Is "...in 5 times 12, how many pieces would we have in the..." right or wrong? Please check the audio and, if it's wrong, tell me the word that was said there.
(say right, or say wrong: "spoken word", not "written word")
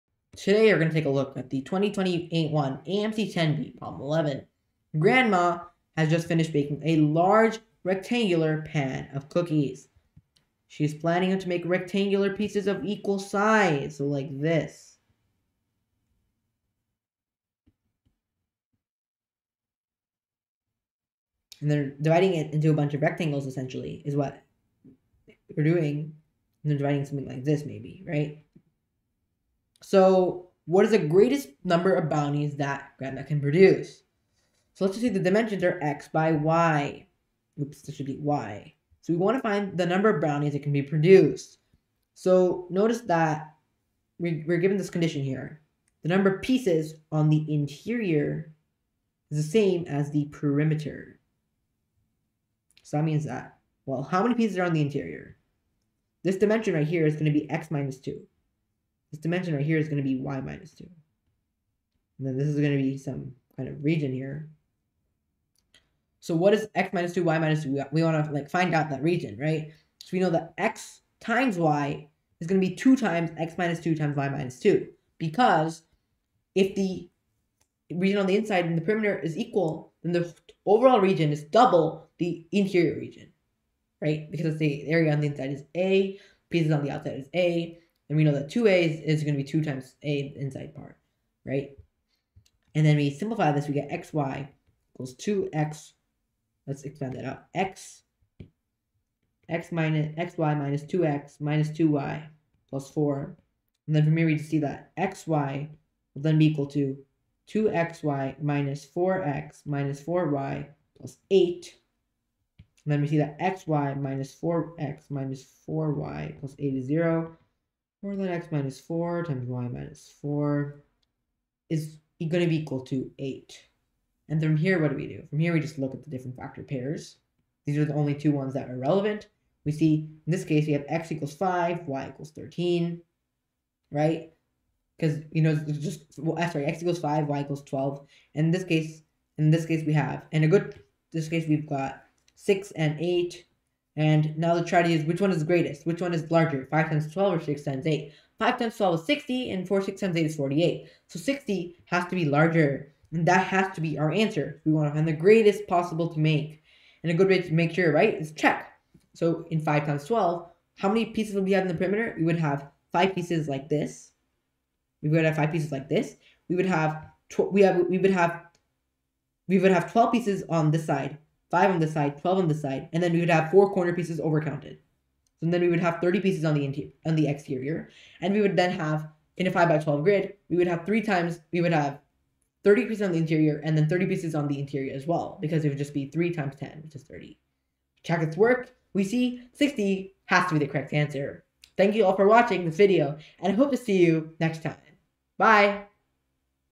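right.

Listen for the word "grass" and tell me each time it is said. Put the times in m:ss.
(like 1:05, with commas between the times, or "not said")
not said.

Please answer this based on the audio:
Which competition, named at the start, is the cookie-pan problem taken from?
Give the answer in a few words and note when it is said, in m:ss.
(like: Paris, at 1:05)
2021 AMC 10B, at 0:01.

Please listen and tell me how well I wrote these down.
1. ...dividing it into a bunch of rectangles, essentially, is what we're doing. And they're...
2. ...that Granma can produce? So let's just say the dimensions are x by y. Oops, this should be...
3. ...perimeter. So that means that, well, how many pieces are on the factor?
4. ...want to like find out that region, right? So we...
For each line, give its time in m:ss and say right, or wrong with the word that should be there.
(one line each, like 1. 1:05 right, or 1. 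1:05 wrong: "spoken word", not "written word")
1. 0:22 right
2. 0:32 right
3. 0:50 wrong: "interior", not "factor"
4. 1:08 right.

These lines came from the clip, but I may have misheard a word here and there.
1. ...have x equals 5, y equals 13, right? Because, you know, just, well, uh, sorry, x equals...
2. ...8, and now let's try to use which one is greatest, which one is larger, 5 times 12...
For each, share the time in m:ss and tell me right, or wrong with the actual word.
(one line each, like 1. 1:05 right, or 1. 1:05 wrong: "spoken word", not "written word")
1. 2:10 right
2. 2:22 right.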